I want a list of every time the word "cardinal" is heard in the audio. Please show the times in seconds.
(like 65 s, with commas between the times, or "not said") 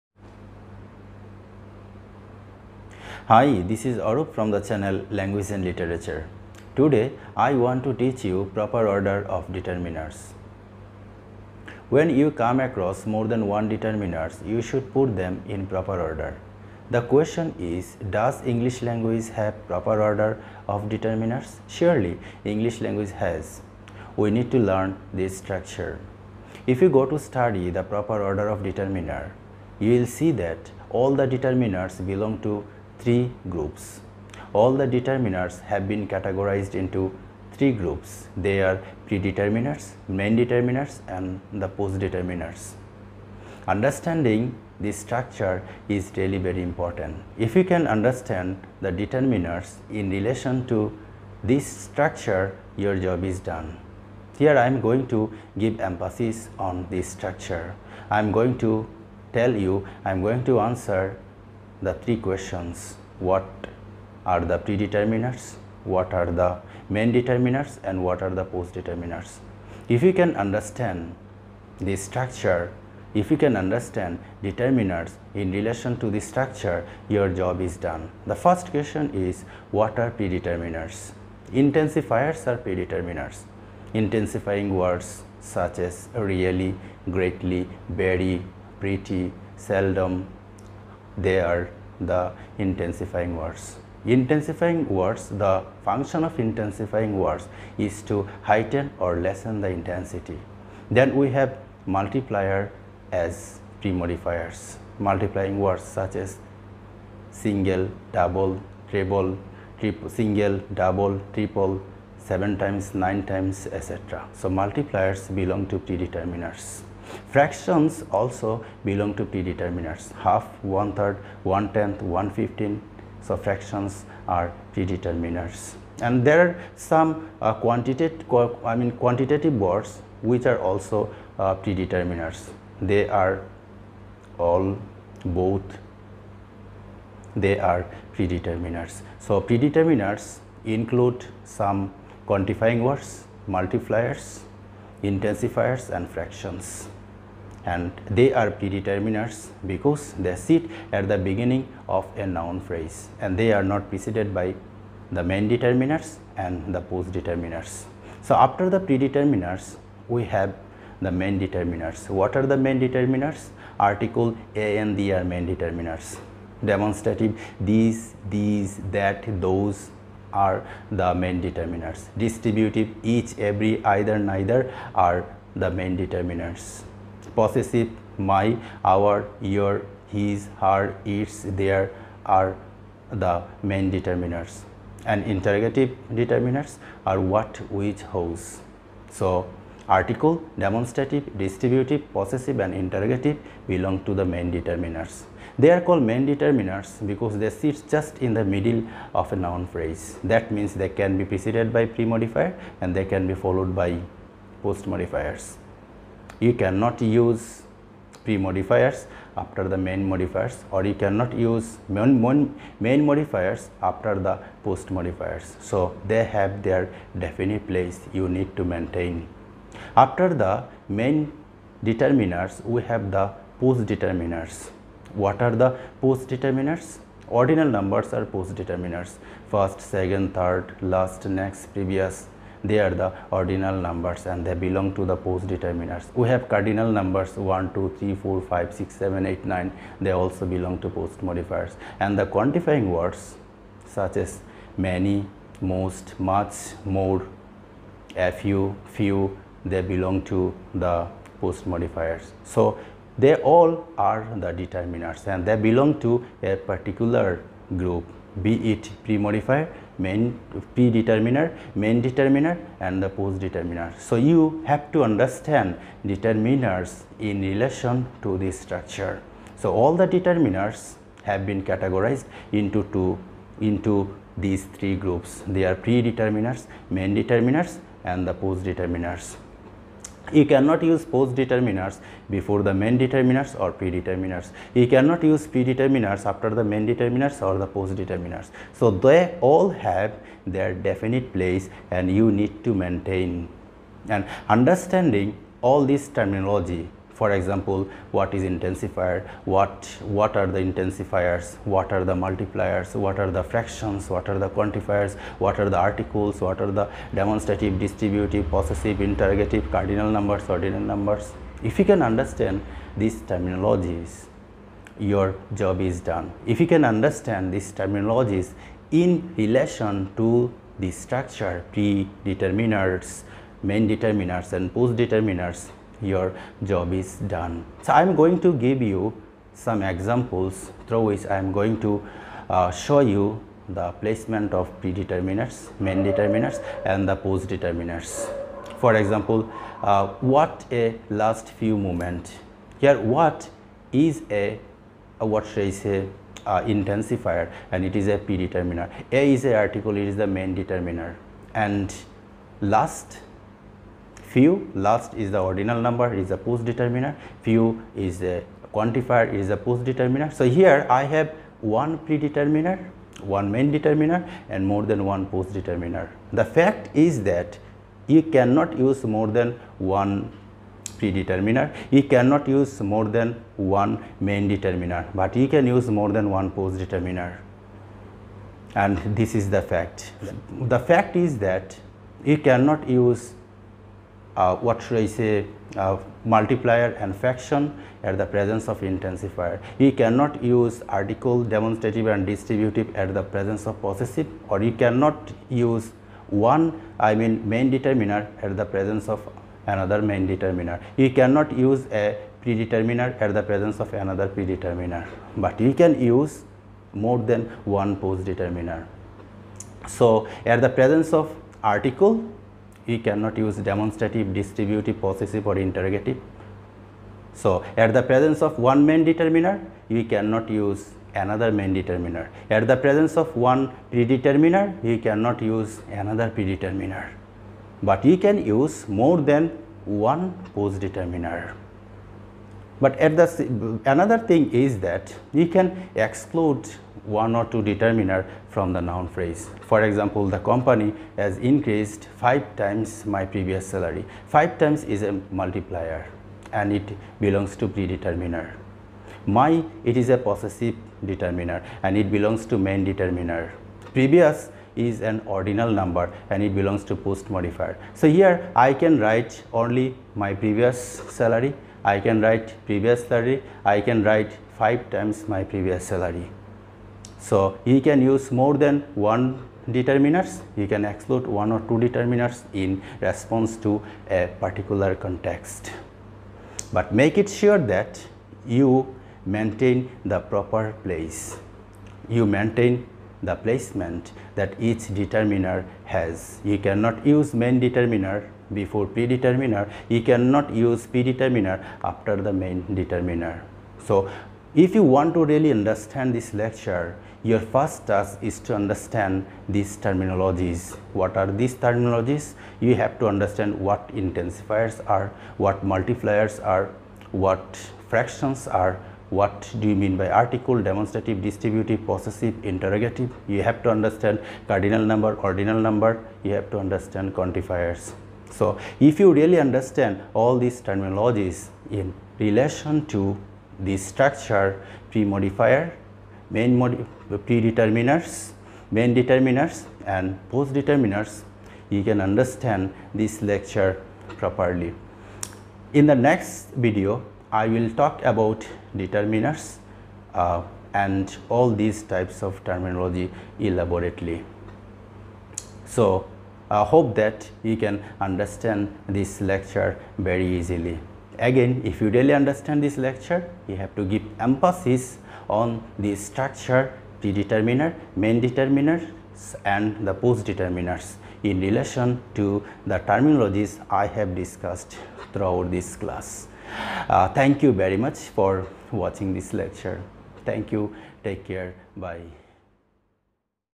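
236 s, 309 s, 514 s.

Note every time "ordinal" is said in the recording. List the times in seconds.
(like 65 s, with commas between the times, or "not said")
227 s, 233 s, 310 s, 355 s, 455 s, 515 s.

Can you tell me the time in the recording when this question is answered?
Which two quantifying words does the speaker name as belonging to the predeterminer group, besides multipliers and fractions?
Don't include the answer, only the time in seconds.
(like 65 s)
134 s.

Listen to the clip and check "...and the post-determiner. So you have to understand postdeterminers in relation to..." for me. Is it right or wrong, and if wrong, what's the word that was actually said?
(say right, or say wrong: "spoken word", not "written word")
wrong: "determiners", not "postdeterminers".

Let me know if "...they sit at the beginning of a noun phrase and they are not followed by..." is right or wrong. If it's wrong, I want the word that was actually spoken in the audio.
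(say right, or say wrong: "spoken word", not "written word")
wrong: "preceded", not "followed".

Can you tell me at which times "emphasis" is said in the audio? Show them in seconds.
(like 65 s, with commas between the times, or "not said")
55 s, 554 s.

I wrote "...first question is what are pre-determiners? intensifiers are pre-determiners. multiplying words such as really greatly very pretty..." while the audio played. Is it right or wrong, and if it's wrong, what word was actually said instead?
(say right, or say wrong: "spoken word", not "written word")
wrong: "intensifying", not "multiplying".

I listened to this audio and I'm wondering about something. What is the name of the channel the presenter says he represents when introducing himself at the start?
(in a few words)
Language and Literature.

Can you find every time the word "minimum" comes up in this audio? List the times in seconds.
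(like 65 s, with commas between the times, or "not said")
not said.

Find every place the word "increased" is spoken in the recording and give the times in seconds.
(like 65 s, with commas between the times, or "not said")
441 s.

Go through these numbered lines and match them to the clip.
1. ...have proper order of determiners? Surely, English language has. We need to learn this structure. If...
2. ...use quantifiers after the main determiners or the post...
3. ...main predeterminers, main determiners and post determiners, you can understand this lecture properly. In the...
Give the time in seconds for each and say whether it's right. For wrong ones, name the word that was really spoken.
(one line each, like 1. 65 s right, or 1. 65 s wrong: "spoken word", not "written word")
1. 19 s right
2. 285 s wrong: "predeterminers", not "quantifiers"
3. 526 s right.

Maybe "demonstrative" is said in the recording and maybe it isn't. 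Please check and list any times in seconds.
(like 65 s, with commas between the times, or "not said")
166 s, 190 s, 307 s, 391 s, 413 s, 510 s.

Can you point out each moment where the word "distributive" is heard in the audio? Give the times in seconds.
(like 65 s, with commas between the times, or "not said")
172 s, 191 s, 307 s, 392 s, 414 s, 511 s.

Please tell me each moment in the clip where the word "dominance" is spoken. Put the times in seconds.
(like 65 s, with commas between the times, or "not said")
not said.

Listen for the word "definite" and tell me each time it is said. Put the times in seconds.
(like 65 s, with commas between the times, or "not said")
217 s, 290 s.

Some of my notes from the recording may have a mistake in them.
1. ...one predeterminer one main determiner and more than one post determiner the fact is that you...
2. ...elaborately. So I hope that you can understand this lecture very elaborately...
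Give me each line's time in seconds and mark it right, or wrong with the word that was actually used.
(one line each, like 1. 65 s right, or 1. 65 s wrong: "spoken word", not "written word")
1. 361 s right
2. 543 s wrong: "easily", not "elaborately".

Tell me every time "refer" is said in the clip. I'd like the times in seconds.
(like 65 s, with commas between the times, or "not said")
not said.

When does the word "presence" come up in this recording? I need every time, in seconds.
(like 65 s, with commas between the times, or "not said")
388 s, 393 s, 398 s, 403 s, 410 s, 418 s, 422 s.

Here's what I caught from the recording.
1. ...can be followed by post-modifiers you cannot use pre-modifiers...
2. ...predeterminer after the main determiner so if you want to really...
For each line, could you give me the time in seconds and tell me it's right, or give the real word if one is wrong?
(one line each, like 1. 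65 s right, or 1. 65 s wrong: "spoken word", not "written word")
1. 203 s right
2. 490 s right.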